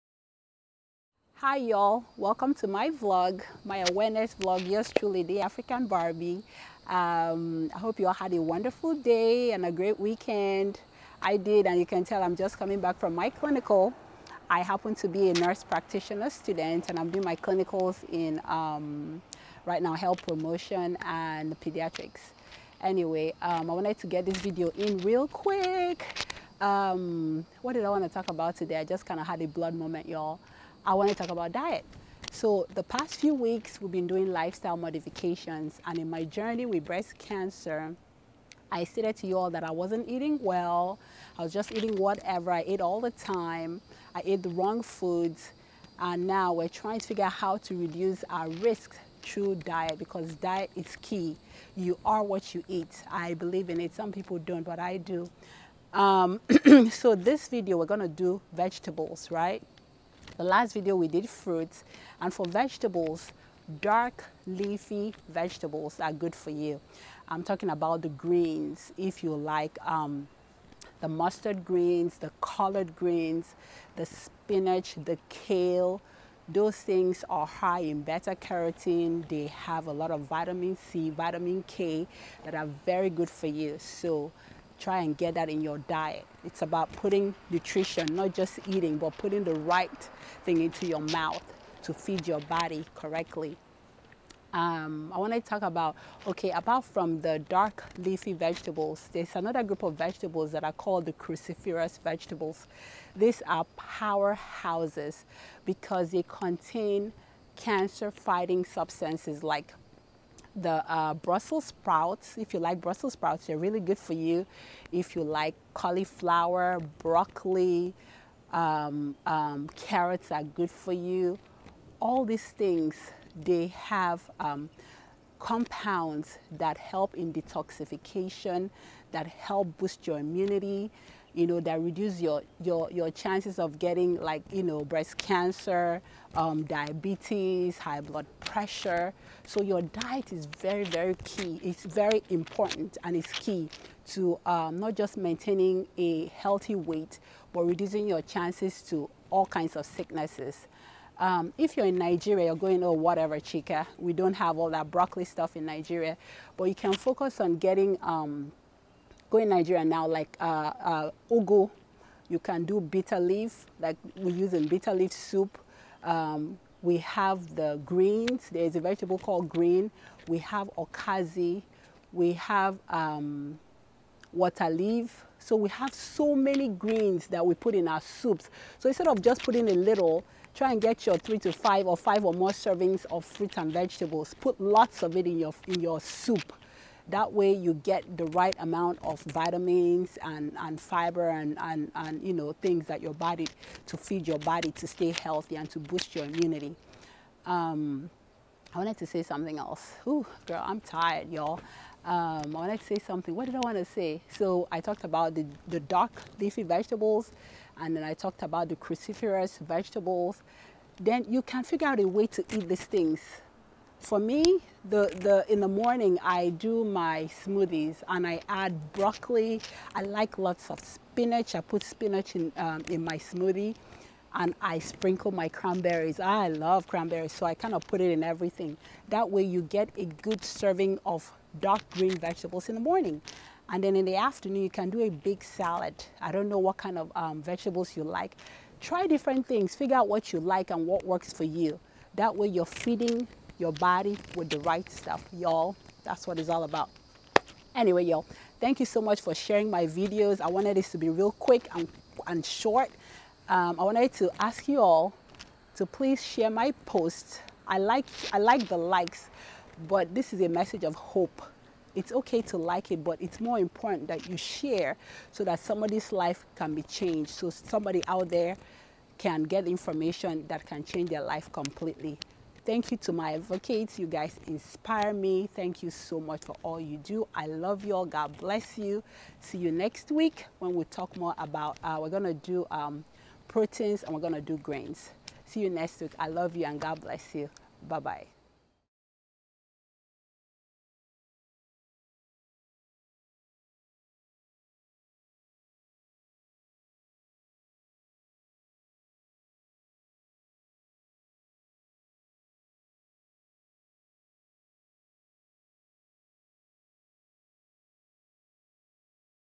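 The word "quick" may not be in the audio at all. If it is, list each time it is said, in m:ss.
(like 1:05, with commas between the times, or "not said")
0:25, 4:11.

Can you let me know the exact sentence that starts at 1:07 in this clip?
I'm talking about the greens if you like um, the mustard greens, the collard greens, the spinach, the kale.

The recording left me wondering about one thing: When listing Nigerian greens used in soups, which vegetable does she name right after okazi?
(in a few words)
Water leaf.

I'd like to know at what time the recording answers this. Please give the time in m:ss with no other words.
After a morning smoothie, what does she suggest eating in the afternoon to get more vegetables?
3:55.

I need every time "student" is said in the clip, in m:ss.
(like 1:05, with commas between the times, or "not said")
0:16.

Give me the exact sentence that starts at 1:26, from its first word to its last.
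It's about putting nutrition, not just eating, but putting the right thing into your mouth to feed your body correctly.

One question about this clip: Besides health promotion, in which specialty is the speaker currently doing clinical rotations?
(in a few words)
Pediatrics.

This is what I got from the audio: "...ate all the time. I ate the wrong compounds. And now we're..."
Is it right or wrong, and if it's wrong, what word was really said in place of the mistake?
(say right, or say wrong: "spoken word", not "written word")
wrong: "foods", not "compounds".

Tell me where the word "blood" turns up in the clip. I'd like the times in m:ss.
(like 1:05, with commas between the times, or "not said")
0:29, 2:18.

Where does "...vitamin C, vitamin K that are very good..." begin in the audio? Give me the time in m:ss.
1:20.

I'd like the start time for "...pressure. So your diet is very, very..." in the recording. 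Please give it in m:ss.
2:18.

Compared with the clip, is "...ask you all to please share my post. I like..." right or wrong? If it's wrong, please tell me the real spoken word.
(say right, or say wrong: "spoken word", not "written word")
right.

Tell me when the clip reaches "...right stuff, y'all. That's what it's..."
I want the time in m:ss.
4:04.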